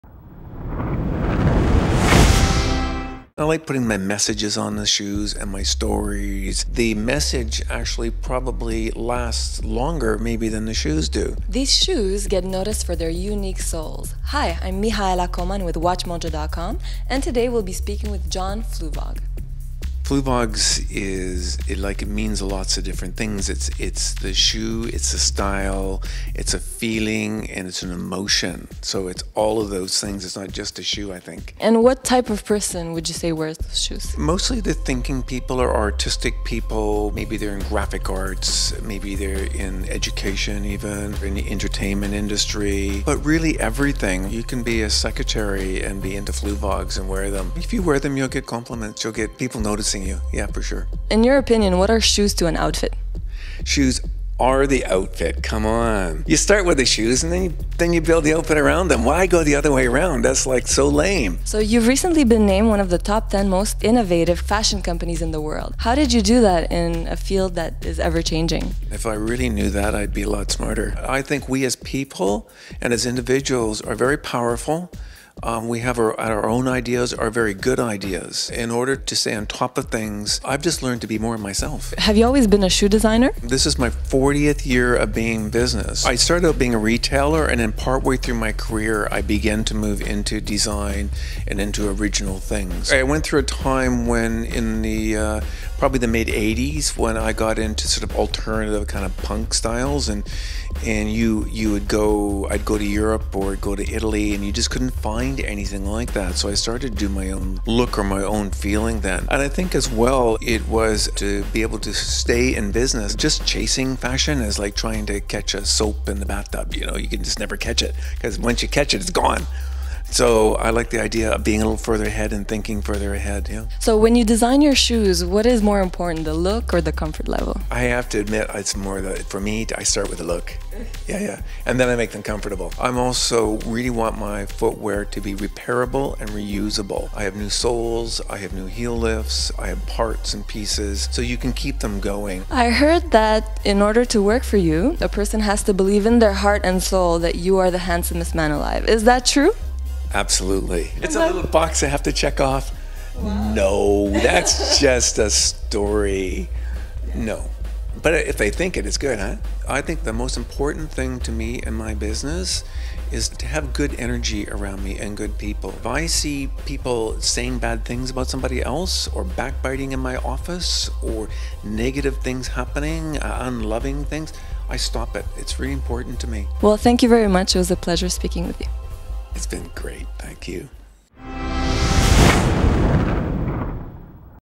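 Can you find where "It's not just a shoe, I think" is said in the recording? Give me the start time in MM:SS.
00:30.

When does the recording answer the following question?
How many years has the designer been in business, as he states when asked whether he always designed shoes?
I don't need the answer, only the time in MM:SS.
01:23.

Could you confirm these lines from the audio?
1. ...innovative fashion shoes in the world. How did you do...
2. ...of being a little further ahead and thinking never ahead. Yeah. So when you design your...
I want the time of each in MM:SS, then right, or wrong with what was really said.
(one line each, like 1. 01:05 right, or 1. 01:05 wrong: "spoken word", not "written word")
1. 01:03 wrong: "companies", not "shoes"
2. 02:01 wrong: "further", not "never".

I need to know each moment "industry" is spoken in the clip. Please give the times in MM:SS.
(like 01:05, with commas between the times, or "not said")
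00:42.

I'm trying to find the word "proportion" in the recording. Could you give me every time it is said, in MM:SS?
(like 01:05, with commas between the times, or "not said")
not said.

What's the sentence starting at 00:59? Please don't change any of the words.
Why go the other way around?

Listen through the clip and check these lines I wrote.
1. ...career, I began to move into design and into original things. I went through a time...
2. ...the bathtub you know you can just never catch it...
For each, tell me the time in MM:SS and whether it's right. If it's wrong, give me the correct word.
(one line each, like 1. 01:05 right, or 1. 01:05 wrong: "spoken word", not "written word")
1. 01:28 right
2. 01:56 right.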